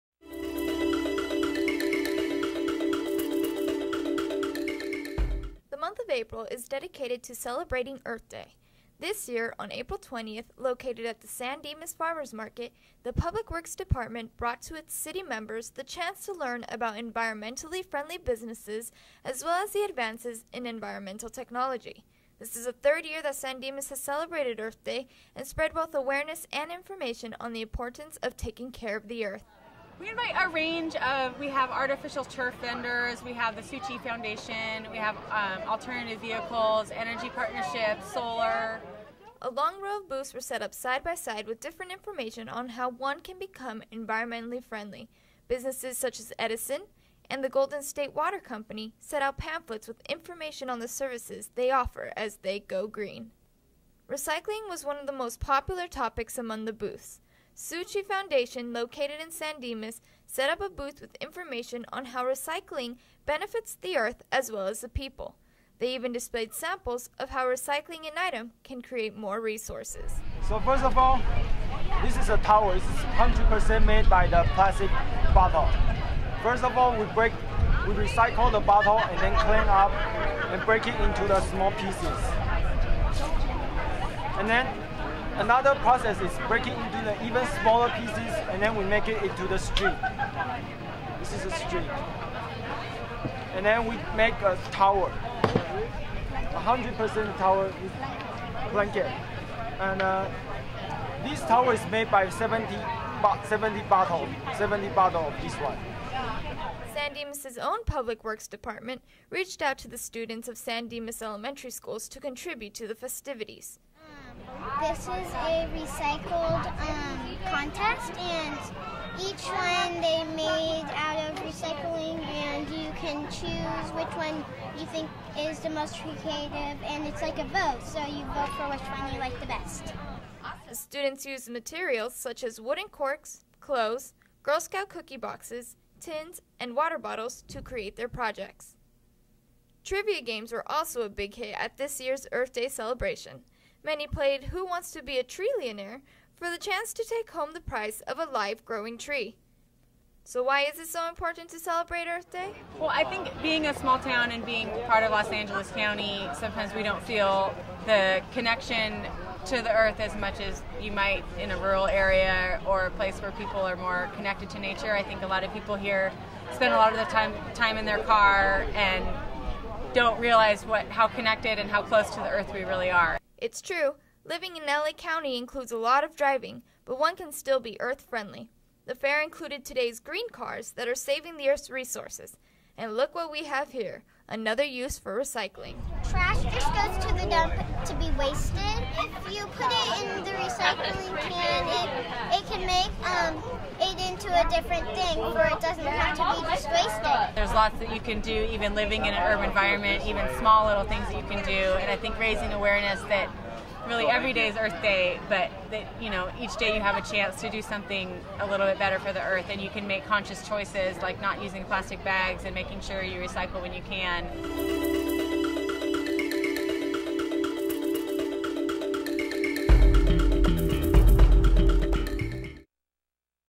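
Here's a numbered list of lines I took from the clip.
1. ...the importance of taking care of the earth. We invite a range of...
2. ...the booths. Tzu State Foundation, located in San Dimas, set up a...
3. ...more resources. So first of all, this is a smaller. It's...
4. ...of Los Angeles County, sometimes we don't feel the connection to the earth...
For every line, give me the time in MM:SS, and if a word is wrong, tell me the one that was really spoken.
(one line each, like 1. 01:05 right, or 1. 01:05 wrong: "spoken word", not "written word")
1. 00:27 right
2. 00:56 wrong: "Chi", not "State"
3. 01:09 wrong: "tower", not "smaller"
4. 02:35 right.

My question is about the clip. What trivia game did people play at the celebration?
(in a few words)
Who Wants to Be a Trillionaire.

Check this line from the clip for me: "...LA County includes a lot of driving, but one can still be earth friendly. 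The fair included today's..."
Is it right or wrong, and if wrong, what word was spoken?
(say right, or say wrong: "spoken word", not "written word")
right.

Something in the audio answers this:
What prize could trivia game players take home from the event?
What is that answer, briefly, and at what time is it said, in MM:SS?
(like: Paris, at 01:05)
A live growing tree, at 02:28.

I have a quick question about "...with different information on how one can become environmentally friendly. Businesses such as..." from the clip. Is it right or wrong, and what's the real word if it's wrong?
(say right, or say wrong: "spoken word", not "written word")
right.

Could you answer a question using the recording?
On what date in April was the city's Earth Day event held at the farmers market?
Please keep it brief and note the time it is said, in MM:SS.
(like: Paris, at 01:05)
April 20th, at 00:09.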